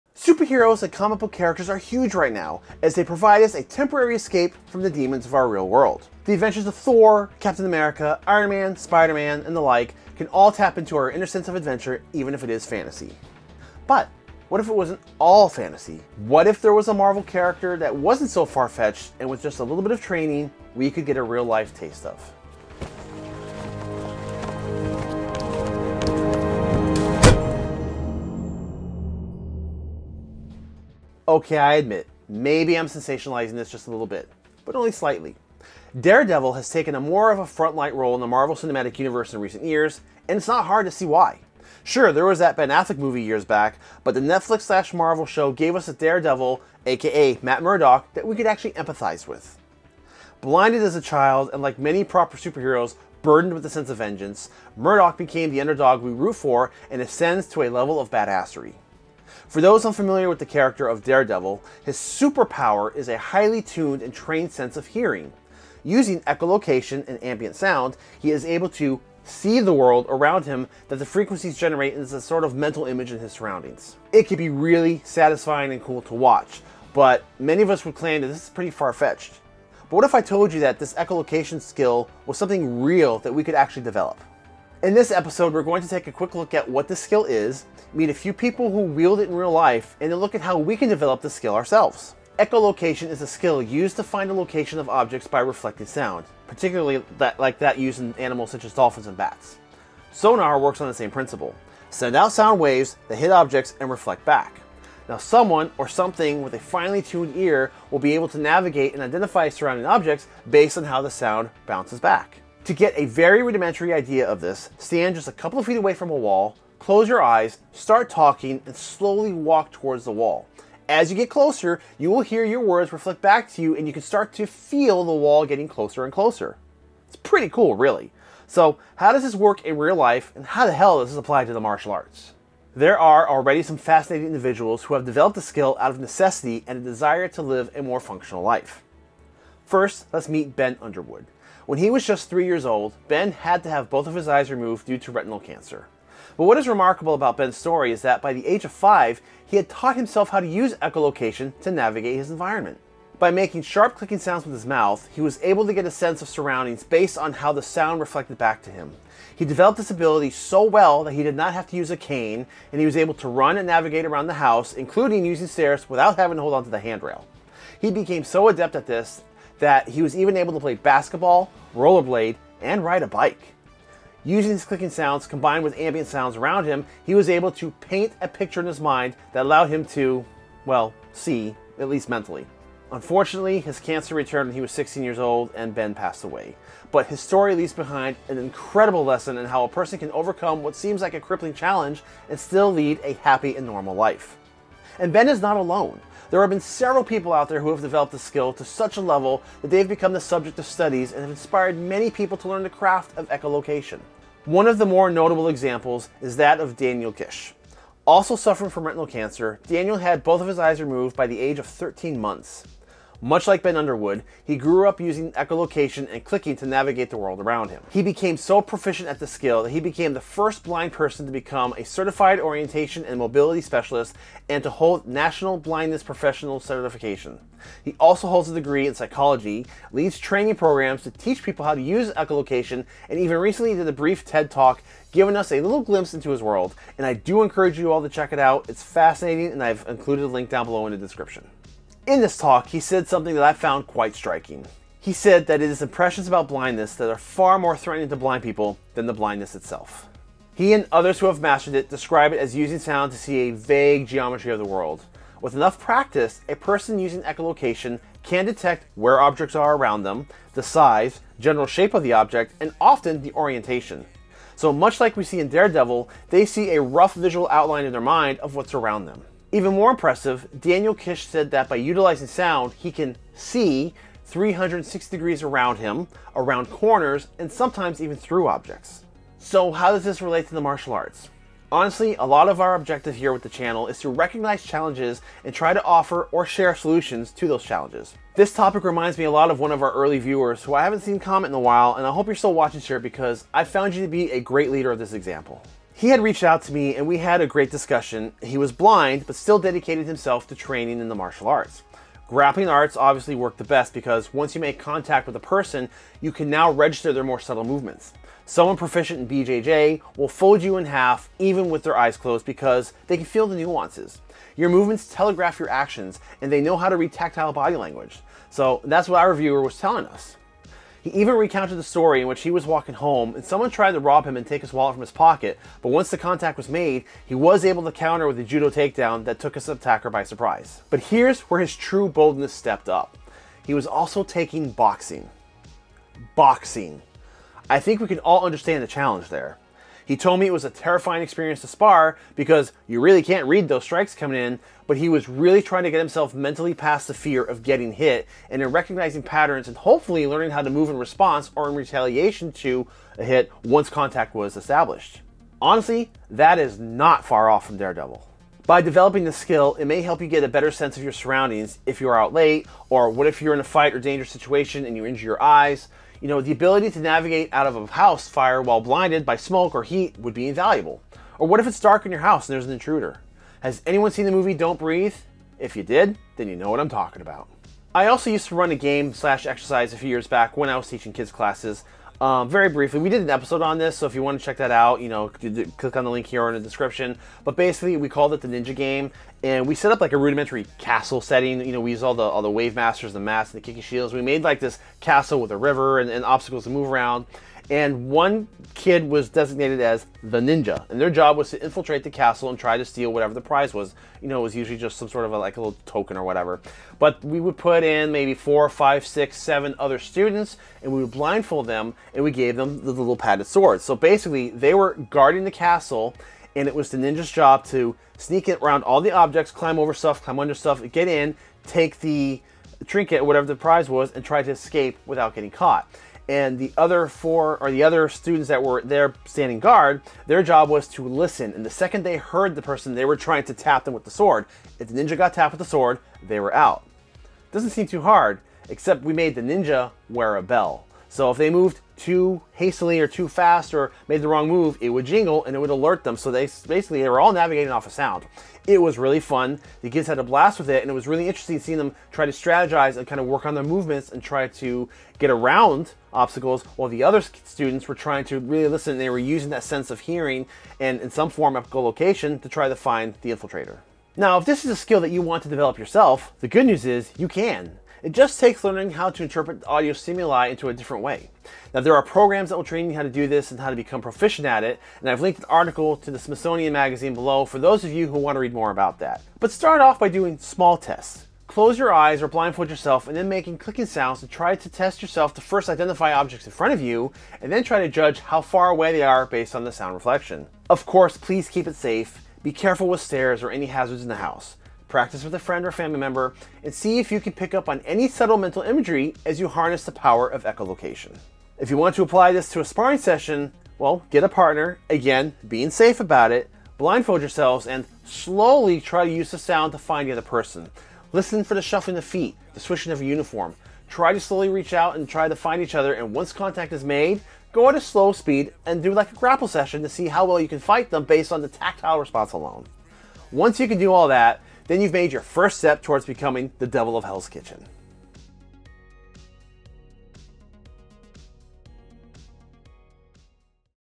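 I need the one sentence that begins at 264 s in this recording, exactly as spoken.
So much like we see in Daredevil, they see a rough visual outline in their mind of what's around them.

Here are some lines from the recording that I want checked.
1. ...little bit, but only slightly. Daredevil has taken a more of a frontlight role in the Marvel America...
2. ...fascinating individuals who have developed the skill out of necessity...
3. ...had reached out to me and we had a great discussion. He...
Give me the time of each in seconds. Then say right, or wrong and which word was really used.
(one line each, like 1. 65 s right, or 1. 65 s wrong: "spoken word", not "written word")
1. 33 s wrong: "Cinematic", not "America"
2. 133 s right
3. 296 s right.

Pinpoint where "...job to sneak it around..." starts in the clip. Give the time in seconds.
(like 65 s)
417 s.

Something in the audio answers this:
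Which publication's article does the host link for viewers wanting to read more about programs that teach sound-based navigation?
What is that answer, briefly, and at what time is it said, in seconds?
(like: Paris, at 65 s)
Smithsonian Magazine, at 476 s.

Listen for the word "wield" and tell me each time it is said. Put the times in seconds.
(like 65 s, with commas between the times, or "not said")
88 s.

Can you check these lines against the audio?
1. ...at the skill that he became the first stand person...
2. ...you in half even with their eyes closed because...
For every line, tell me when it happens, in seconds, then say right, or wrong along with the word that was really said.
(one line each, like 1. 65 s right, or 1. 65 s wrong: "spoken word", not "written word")
1. 219 s wrong: "blind", not "stand"
2. 310 s right.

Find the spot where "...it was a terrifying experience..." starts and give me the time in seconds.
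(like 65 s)
340 s.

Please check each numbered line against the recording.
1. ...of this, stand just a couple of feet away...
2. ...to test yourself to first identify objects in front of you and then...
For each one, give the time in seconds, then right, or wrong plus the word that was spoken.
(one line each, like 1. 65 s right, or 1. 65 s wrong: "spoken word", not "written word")
1. 114 s right
2. 484 s right.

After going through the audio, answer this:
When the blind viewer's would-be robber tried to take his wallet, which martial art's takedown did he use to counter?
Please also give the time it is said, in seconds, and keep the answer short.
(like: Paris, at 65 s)
Judo, at 328 s.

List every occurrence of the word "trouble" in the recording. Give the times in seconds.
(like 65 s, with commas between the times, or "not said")
not said.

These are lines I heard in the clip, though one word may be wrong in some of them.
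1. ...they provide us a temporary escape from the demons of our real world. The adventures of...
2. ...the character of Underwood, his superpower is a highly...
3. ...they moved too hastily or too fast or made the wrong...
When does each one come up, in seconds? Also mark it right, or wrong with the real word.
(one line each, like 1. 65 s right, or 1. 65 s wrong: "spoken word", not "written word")
1. 2 s right
2. 60 s wrong: "Daredevil", not "Underwood"
3. 441 s right.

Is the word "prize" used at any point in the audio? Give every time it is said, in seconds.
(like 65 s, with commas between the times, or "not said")
403 s, 423 s.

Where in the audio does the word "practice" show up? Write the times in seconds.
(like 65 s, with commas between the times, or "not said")
255 s, 494 s.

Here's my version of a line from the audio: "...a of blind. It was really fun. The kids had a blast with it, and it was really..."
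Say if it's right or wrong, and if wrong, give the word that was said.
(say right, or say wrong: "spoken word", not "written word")
wrong: "sound", not "blind".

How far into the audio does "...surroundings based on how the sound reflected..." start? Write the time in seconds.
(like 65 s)
156 s.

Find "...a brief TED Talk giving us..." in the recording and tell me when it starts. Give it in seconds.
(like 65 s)
233 s.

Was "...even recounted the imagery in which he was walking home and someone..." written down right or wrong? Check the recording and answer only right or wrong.
wrong.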